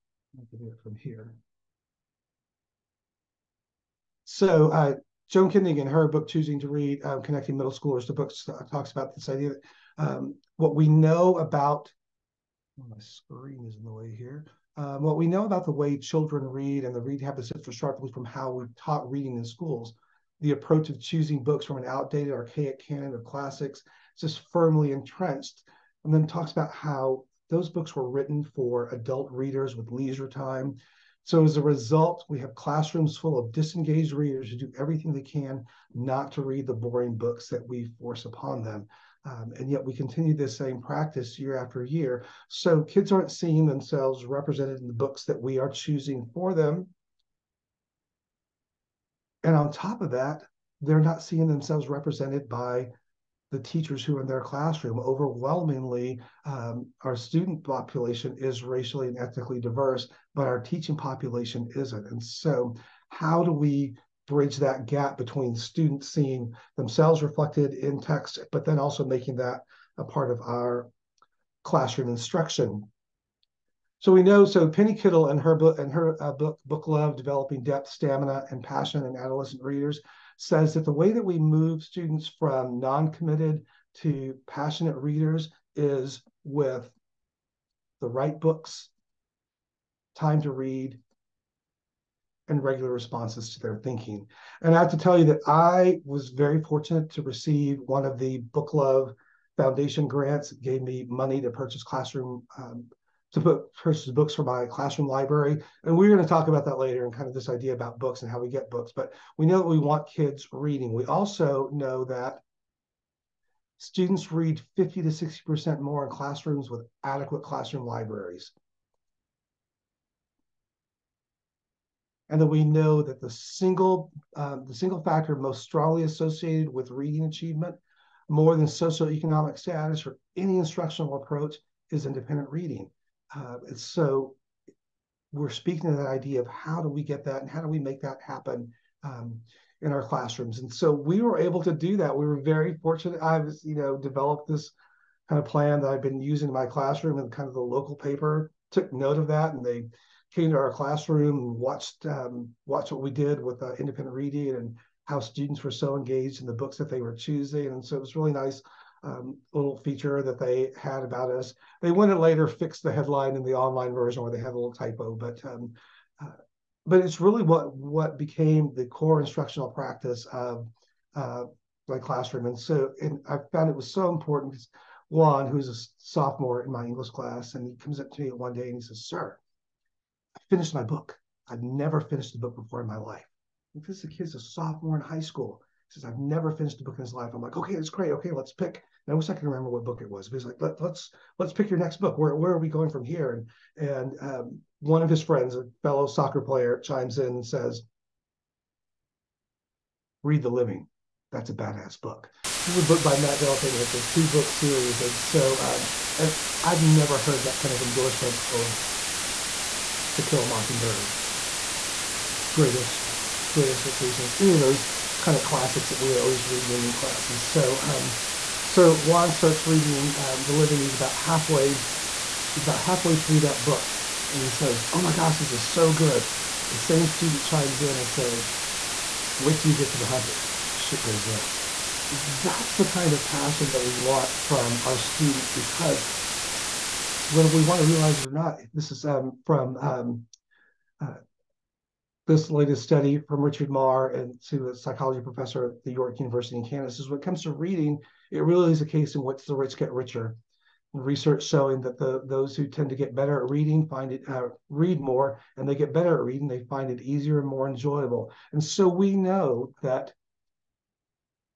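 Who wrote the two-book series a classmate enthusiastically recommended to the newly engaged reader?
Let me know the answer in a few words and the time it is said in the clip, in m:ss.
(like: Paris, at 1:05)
Matt de la Peña, at 3:23.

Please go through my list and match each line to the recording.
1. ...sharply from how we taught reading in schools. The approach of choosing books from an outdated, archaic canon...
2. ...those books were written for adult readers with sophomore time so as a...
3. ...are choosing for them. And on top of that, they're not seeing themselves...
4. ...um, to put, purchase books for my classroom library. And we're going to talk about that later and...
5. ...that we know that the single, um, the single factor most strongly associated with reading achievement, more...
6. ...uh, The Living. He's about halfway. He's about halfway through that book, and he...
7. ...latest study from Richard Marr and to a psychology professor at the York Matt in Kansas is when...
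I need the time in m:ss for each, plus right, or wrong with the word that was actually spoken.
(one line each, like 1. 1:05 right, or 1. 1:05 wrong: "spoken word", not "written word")
1. 0:17 right
2. 0:27 wrong: "leisure", not "sophomore"
3. 0:45 right
4. 1:42 right
5. 2:02 right
6. 3:40 right
7. 4:02 wrong: "University", not "Matt".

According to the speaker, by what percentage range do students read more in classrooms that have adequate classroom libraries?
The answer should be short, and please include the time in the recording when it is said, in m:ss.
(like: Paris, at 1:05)
50 to 60%, at 1:54.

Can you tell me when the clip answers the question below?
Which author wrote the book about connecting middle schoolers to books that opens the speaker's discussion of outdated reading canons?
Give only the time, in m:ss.
0:05.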